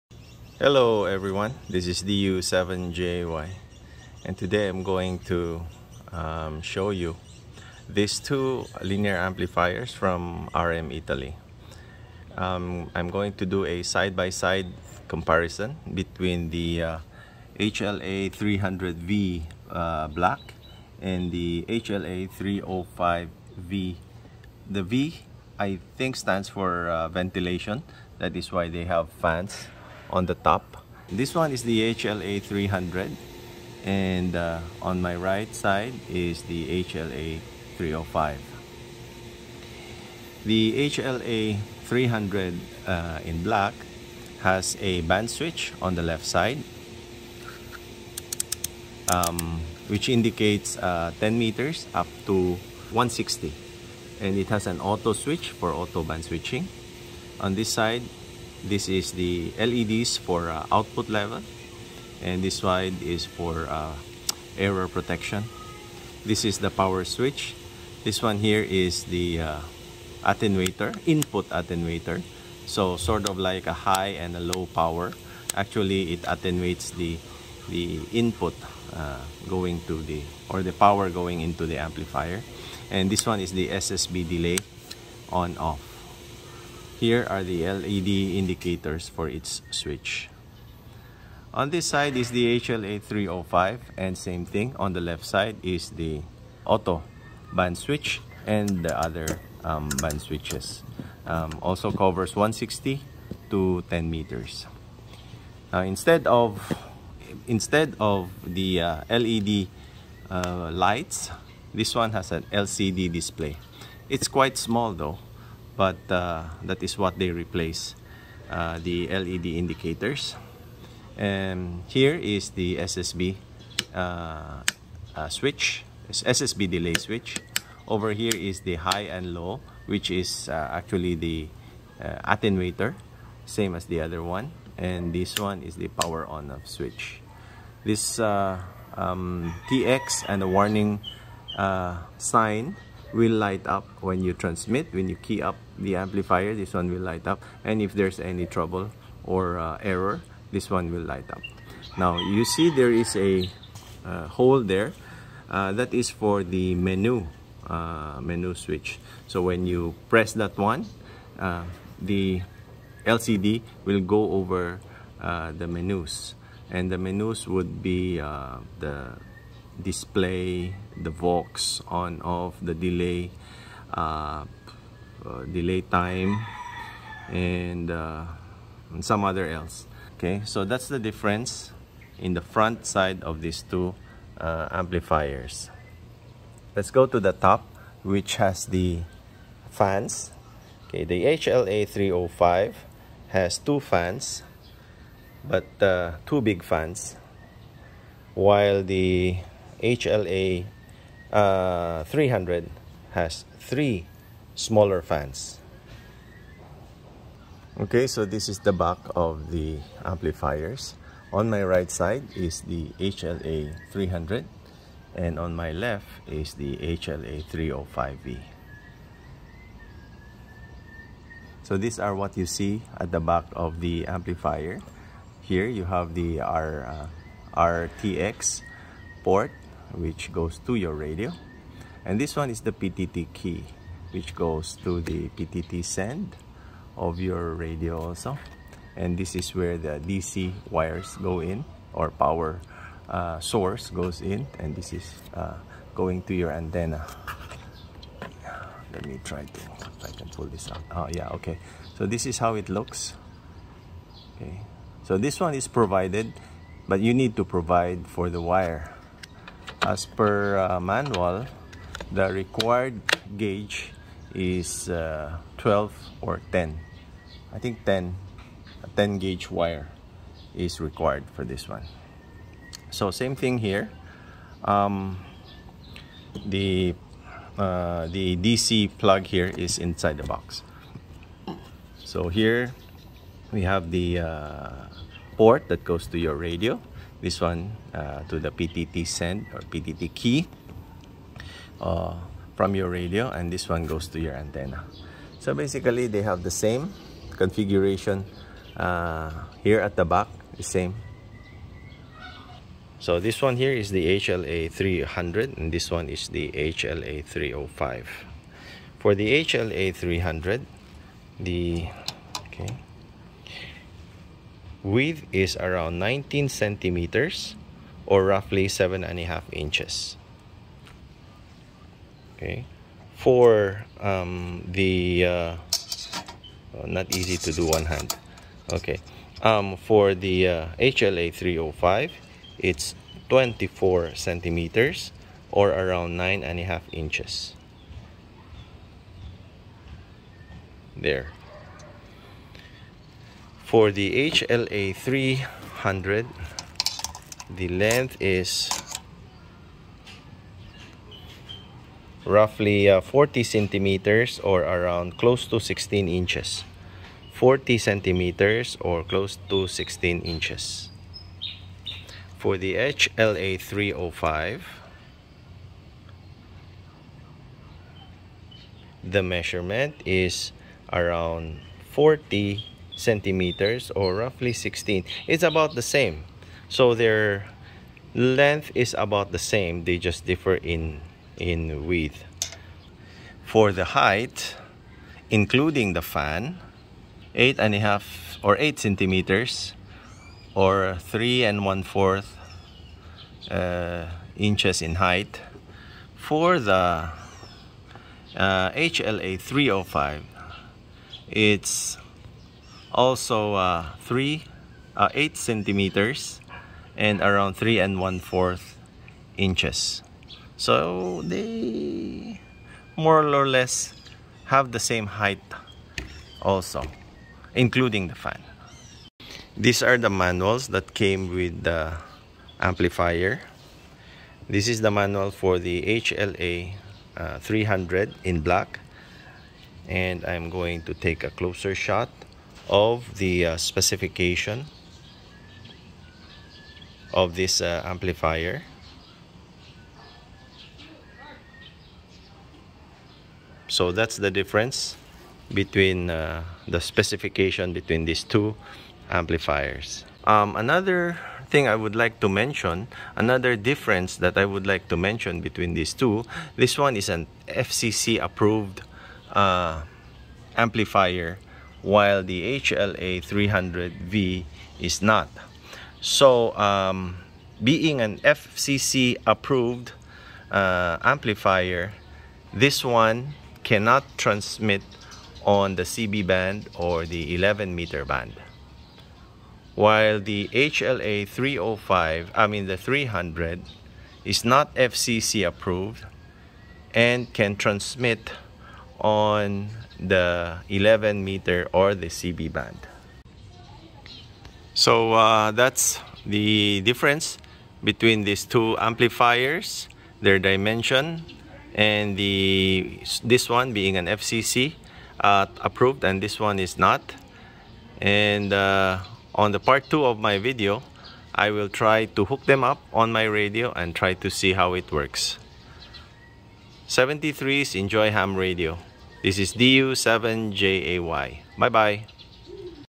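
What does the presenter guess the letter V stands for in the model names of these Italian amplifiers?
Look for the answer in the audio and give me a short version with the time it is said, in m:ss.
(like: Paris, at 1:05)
Ventilation, at 0:27.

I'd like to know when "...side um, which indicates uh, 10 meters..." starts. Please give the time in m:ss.
0:46.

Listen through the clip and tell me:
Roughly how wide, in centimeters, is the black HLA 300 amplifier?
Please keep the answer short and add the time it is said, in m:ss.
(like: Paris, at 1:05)
19 centimeters, at 5:15.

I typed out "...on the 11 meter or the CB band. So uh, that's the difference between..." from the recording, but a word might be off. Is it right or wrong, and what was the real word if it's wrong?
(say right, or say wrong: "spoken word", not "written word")
right.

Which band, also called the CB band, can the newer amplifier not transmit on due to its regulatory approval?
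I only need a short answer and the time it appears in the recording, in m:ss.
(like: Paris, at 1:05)
11 meter band, at 7:57.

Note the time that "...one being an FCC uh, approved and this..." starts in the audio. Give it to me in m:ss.
8:23.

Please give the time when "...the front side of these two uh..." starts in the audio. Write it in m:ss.
3:02.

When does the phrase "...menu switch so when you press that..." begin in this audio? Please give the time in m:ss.
2:38.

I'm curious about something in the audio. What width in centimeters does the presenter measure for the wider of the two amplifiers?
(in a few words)
24 centimeters.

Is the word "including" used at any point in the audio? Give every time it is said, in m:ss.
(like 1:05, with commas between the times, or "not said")
6:25, 6:57.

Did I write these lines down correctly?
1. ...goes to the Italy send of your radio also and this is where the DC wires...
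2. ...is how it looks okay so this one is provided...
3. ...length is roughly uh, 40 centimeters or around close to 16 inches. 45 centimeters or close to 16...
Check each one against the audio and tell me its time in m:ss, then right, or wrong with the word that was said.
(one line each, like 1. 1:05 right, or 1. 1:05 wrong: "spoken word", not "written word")
1. 3:54 wrong: "PTT", not "Italy"
2. 4:12 right
3. 5:47 wrong: "40", not "45".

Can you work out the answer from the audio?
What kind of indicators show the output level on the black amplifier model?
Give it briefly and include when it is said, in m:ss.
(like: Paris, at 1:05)
LEDs, at 0:59.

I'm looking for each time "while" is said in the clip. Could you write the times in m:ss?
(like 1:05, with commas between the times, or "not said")
3:18, 7:41, 7:59.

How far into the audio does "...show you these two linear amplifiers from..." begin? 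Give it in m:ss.
0:06.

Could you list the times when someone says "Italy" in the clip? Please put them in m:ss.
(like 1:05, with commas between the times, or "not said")
0:10.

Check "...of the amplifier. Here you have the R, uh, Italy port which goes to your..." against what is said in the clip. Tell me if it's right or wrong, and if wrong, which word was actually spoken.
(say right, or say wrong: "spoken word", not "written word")
wrong: "RTX", not "Italy".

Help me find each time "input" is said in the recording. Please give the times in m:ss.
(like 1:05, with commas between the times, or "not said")
1:11, 1:18.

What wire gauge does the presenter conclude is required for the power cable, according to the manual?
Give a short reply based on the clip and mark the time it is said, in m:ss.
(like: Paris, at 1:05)
10 gauge, at 4:28.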